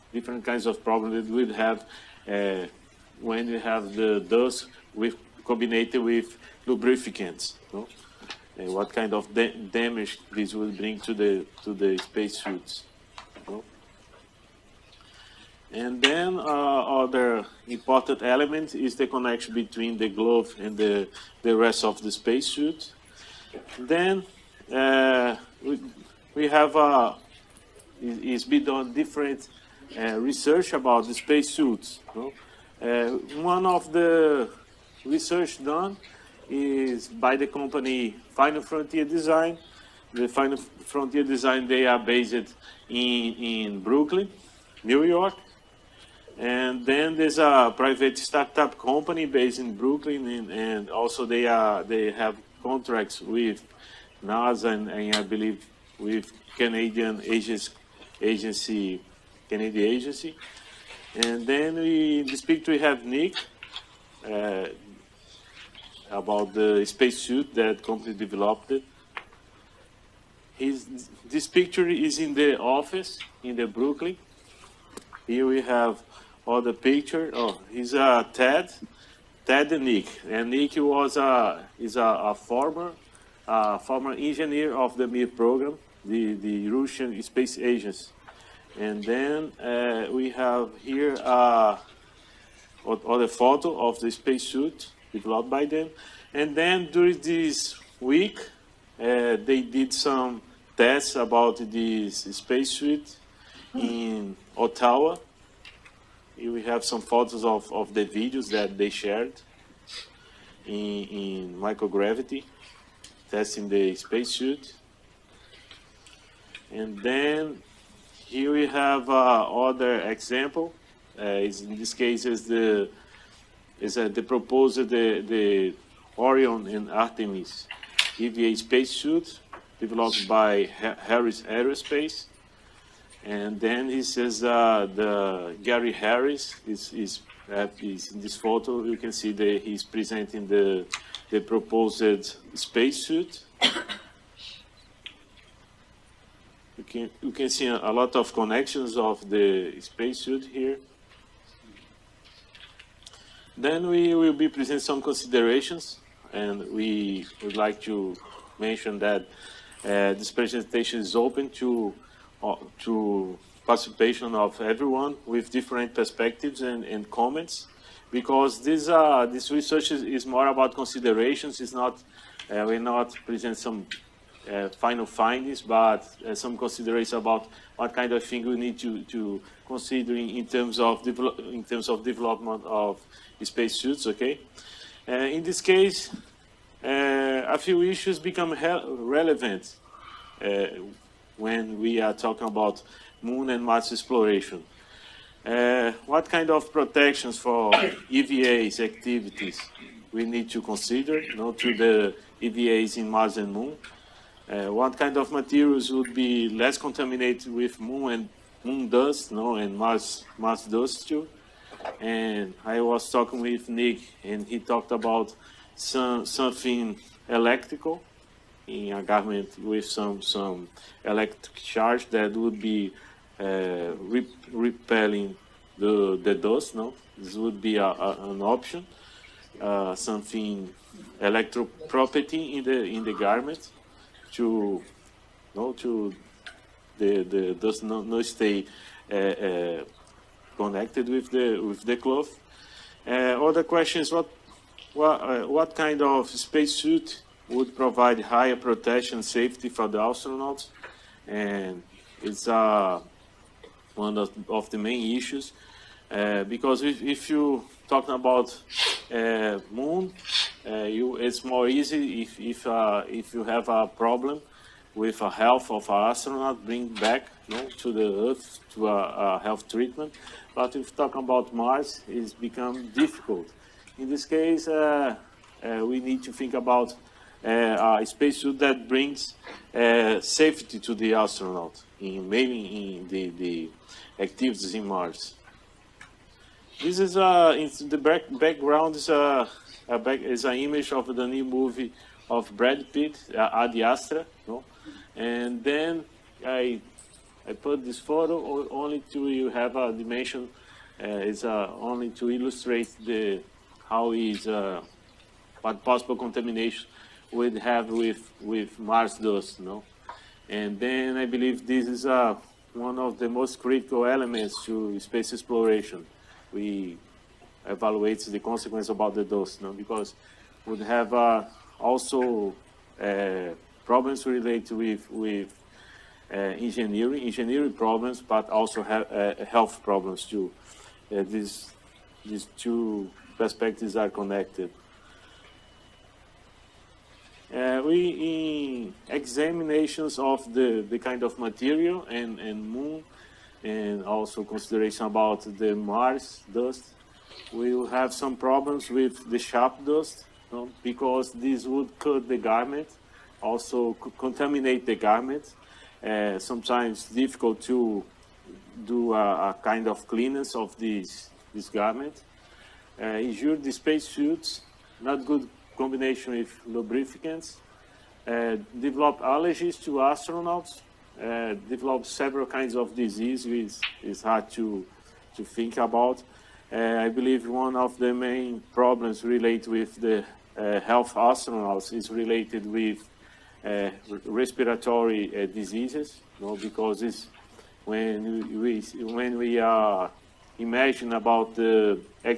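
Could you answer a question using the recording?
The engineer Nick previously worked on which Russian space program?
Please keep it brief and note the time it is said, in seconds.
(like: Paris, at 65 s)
Mir, at 85 s.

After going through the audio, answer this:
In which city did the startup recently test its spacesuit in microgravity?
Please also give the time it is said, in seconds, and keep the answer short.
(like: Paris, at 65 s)
Ottawa, at 104 s.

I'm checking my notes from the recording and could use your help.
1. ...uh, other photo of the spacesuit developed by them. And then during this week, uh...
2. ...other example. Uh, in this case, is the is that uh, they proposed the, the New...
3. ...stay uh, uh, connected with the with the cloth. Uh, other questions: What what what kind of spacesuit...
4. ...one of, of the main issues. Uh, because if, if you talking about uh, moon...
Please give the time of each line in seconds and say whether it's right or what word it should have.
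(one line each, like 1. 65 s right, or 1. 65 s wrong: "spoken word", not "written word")
1. 91 s right
2. 119 s wrong: "Orion", not "New"
3. 238 s right
4. 253 s right.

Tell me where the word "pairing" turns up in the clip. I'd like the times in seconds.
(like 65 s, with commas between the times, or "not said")
not said.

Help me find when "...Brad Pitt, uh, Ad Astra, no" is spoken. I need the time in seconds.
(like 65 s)
292 s.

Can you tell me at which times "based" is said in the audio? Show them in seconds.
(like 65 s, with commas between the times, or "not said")
41 s, 49 s.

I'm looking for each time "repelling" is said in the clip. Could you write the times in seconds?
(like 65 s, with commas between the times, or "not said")
224 s.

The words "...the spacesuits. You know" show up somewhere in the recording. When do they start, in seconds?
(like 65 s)
31 s.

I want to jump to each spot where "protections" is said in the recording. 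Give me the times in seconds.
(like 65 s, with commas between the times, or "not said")
196 s, 248 s.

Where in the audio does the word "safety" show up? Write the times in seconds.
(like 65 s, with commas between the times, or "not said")
249 s, 279 s.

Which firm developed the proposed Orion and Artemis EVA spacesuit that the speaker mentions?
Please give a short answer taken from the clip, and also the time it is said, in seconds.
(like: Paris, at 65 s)
Harris Aerospace, at 131 s.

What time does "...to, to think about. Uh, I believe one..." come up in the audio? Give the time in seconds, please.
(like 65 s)
374 s.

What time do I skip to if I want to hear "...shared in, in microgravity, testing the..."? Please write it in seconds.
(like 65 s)
108 s.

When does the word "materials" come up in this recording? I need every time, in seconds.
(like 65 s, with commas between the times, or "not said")
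205 s, 341 s.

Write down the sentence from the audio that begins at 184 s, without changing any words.
Okay, uh, in this case, uh, a few issues become relevant uh, when we are talking about moon and Mars exploration.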